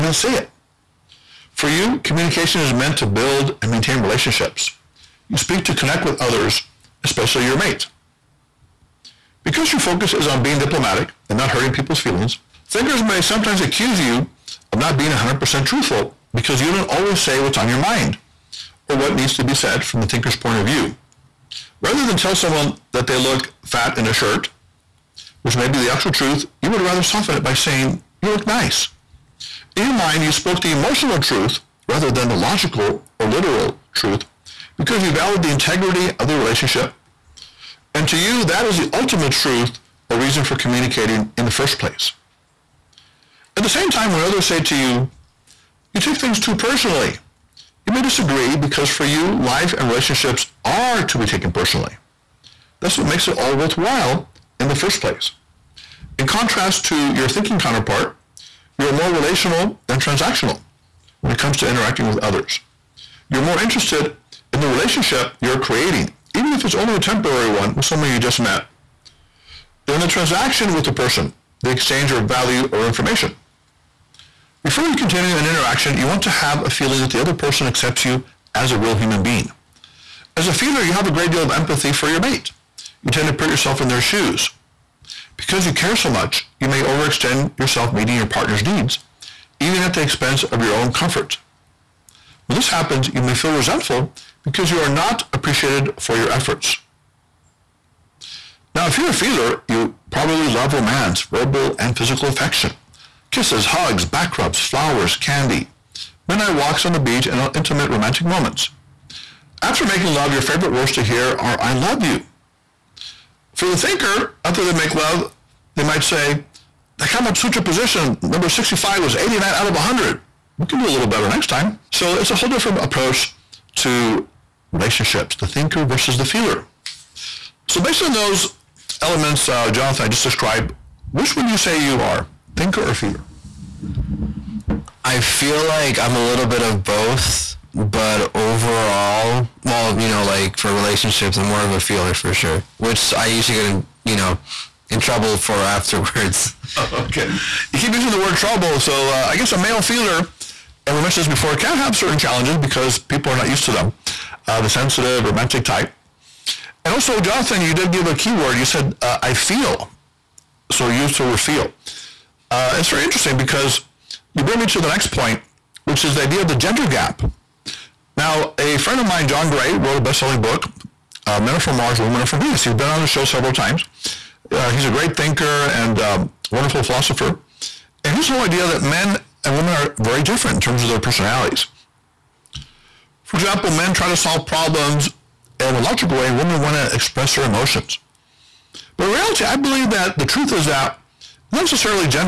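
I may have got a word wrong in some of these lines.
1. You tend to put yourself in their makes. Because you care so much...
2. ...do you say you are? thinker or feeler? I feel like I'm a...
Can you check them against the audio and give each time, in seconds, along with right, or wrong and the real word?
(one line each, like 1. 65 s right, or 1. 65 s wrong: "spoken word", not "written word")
1. 83 s wrong: "shoes", not "makes"
2. 131 s right.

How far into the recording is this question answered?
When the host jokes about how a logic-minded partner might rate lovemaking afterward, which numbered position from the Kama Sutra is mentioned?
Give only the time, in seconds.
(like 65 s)
118 s.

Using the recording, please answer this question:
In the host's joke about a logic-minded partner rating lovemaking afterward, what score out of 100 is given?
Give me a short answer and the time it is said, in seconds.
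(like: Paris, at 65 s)
89, at 119 s.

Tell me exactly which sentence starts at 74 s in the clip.
Before you continue an interaction, you want to have a feeling that the other person accepts you as a real human being.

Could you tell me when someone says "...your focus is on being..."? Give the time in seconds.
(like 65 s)
9 s.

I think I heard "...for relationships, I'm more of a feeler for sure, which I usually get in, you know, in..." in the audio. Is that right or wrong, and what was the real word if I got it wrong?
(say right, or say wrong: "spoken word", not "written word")
right.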